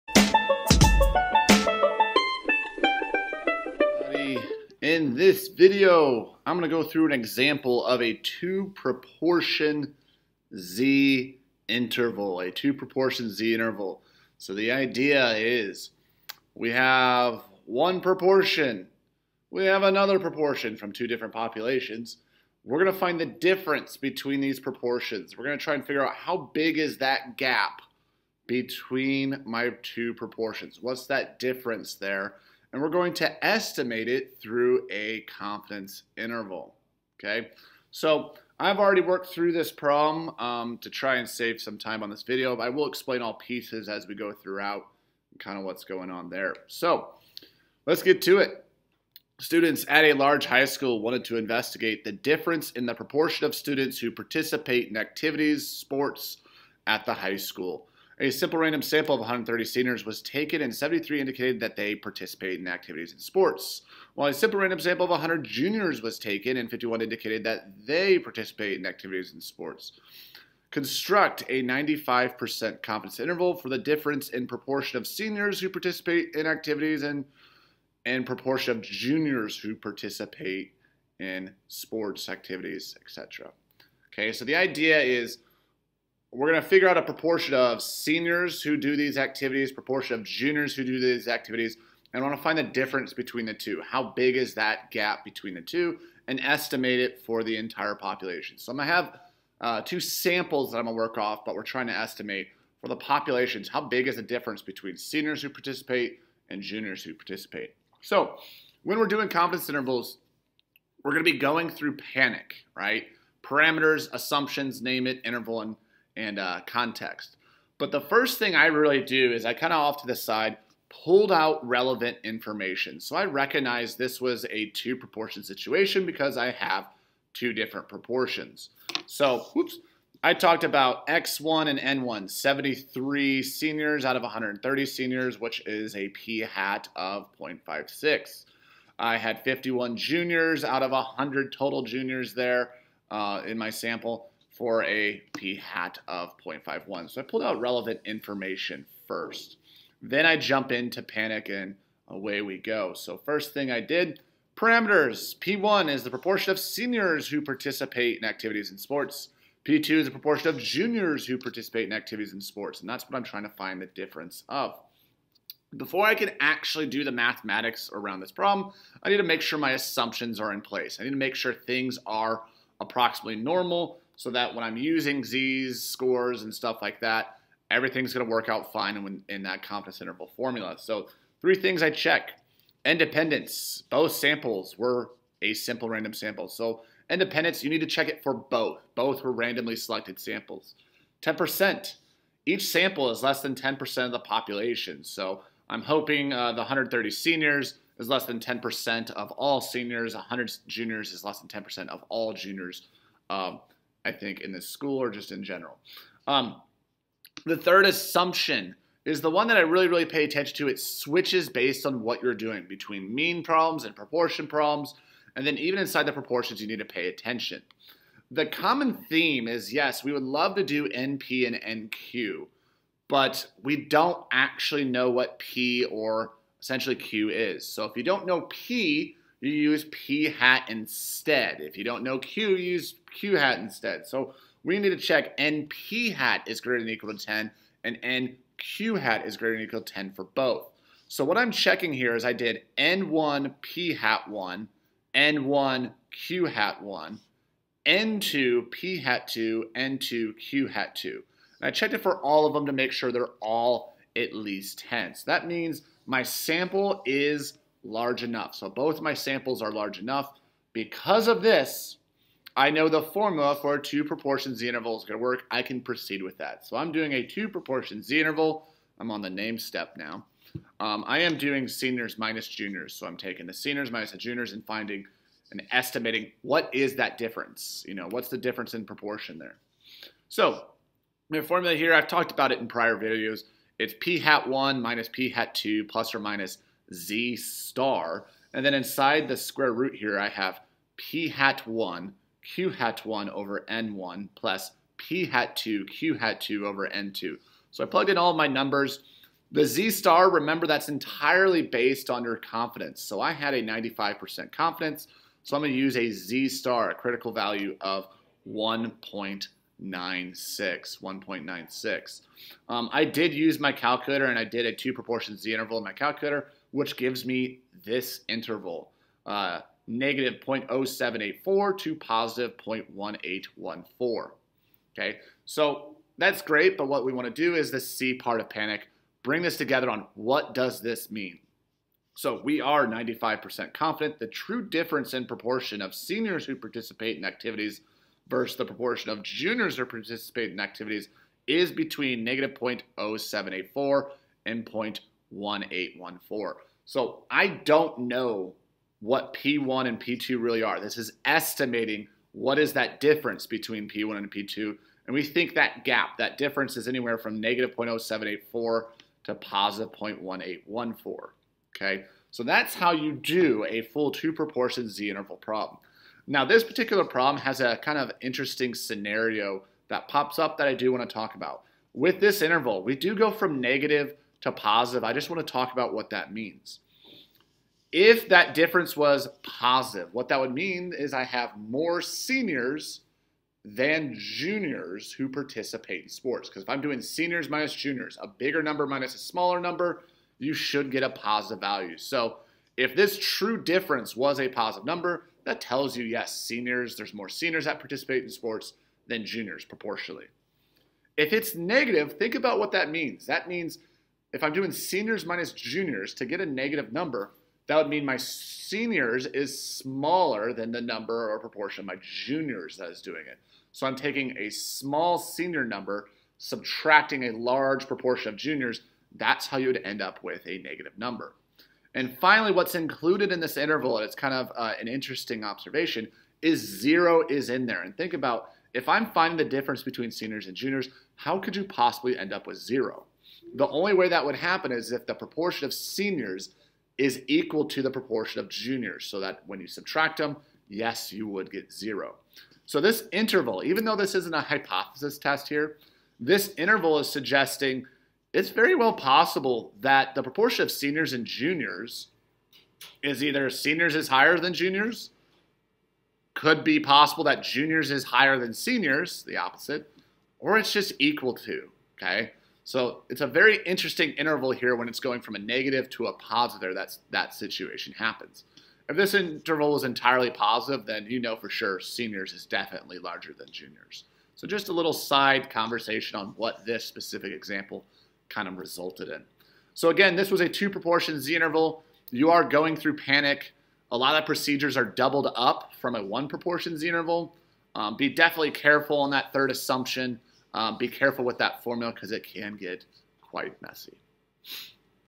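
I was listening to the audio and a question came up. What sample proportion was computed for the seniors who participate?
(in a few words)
0.56.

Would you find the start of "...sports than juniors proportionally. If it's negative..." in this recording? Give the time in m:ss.
6:38.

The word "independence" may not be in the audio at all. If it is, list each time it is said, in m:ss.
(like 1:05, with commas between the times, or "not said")
3:02, 3:07.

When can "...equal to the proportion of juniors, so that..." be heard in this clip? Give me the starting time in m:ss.
7:17.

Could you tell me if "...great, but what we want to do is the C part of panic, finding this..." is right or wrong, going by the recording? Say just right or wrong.
wrong.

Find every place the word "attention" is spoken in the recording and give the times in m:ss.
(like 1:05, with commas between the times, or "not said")
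3:30, 3:37.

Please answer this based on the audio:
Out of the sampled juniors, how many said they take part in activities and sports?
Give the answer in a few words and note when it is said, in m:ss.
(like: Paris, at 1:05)
51, at 1:06.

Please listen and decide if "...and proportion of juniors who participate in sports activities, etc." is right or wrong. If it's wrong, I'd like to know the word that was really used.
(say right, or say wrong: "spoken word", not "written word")
right.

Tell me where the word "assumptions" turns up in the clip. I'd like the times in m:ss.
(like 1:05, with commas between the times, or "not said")
1:54, 2:49, 3:27, 8:09.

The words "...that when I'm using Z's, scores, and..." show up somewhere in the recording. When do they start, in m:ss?
2:54.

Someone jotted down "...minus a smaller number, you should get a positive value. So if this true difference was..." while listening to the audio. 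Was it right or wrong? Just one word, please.
right.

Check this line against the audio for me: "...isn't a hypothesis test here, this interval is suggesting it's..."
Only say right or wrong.
right.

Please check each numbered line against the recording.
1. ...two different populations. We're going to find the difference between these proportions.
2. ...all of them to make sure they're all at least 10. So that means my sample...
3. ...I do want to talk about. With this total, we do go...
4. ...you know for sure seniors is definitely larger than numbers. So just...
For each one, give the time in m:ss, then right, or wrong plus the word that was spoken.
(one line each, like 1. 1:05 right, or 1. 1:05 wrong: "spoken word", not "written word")
1. 0:20 right
2. 4:12 right
3. 6:10 wrong: "interval", not "total"
4. 7:51 wrong: "juniors", not "numbers".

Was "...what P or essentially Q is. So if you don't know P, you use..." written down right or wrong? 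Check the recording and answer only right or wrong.
right.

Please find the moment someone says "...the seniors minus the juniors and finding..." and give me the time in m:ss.
4:33.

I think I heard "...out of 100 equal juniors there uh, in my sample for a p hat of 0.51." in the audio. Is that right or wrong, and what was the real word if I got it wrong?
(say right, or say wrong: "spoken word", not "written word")
wrong: "total", not "equal".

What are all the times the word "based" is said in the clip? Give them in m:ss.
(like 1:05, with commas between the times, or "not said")
3:31, 5:01.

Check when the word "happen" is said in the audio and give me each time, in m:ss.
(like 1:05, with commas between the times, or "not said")
7:14, 7:47.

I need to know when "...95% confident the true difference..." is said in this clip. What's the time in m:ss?
5:32.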